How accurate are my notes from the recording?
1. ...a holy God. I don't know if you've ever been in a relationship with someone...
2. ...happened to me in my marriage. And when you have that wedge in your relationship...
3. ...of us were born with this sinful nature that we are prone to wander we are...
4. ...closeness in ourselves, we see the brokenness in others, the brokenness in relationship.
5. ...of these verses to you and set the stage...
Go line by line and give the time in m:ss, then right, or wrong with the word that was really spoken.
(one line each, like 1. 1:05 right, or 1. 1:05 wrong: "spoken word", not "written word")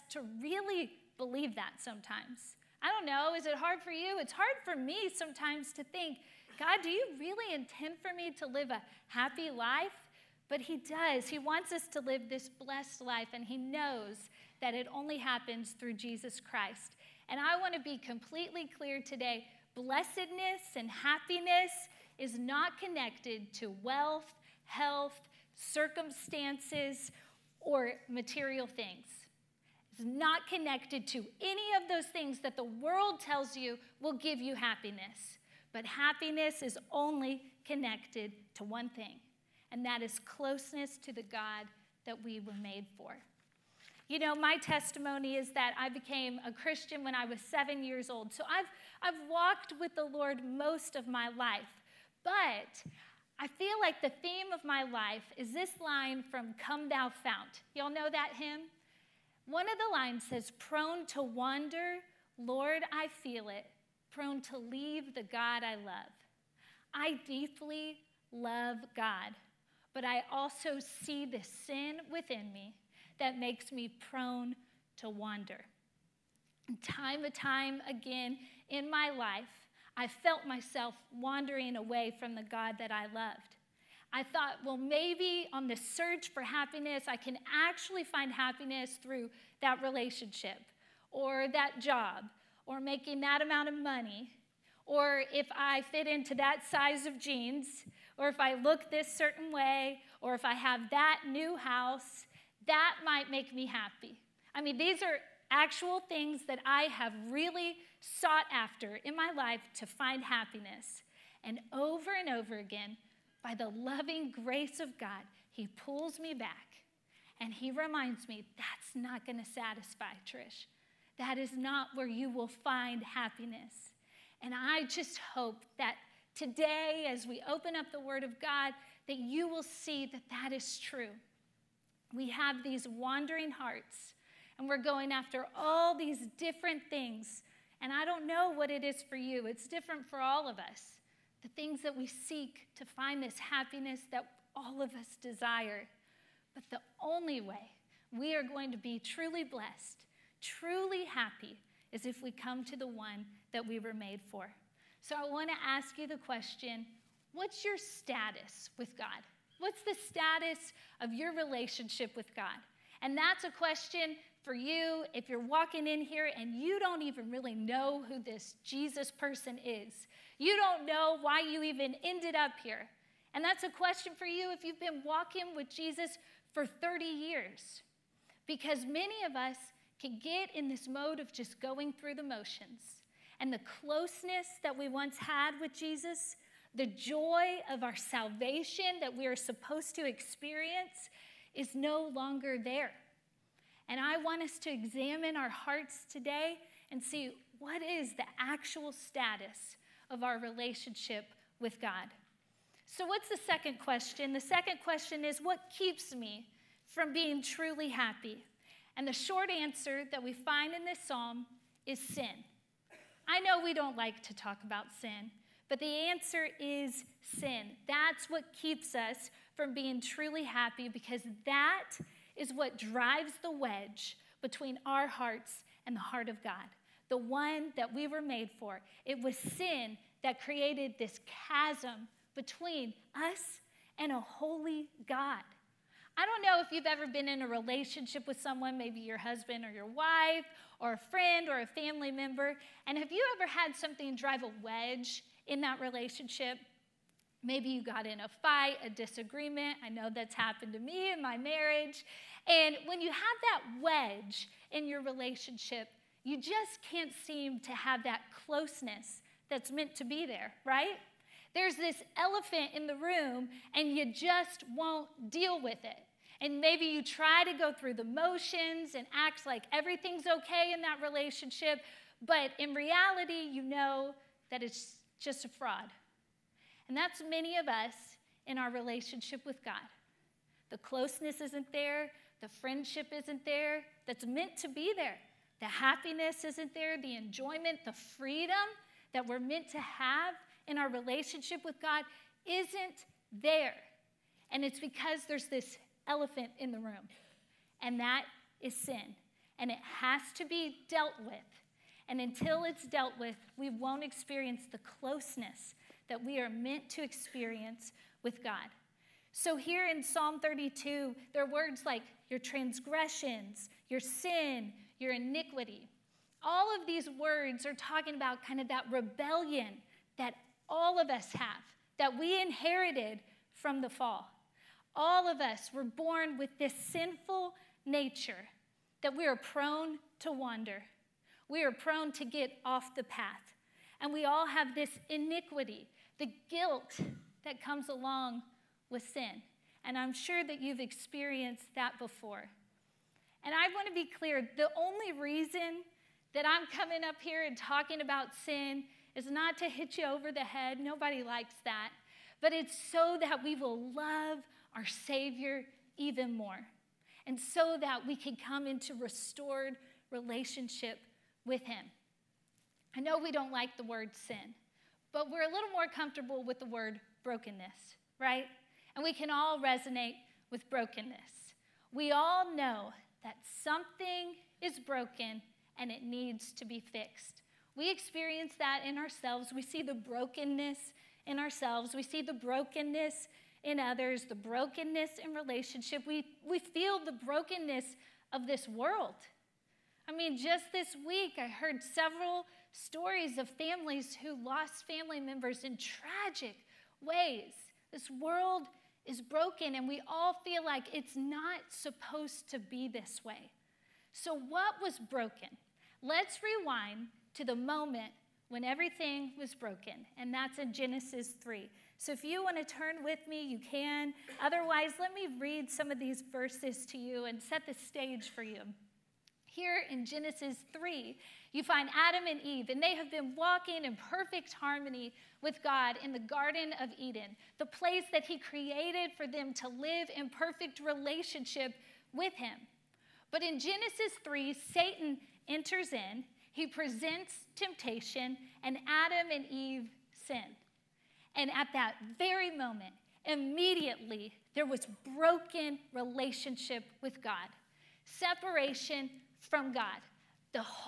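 1. 3:54 right
2. 4:10 right
3. 5:25 right
4. 6:19 wrong: "brokenness", not "closeness"
5. 6:55 right.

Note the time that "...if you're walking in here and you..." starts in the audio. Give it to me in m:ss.
2:45.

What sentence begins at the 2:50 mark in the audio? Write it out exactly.
You don't know why you even ended up here.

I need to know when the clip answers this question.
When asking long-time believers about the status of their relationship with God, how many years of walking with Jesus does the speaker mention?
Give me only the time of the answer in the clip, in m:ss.
2:56.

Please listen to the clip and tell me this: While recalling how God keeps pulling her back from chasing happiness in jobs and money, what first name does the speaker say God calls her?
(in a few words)
Trish.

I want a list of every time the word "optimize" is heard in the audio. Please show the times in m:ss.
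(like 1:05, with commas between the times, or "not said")
not said.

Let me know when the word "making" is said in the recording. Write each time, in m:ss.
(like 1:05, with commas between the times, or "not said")
1:32.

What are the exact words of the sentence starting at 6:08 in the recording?
And we can all resonate with brokenness.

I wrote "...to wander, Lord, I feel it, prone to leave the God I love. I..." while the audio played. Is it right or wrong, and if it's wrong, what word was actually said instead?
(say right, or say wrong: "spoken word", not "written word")
right.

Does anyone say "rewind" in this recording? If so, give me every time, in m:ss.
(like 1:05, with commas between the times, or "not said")
6:46.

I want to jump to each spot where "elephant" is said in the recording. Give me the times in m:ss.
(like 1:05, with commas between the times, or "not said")
4:22, 4:56.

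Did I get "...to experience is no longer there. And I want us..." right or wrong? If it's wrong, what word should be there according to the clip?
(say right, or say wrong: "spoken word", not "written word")
right.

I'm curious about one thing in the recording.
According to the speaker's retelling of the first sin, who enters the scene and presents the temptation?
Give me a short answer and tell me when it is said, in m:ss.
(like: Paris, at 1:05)
Satan, at 7:14.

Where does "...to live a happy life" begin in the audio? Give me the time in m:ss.
0:08.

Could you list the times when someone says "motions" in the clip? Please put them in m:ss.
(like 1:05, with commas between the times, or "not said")
3:02, 4:28.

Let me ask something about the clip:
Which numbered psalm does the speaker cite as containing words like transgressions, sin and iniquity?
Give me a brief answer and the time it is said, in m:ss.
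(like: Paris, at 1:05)
Psalm 32, at 5:10.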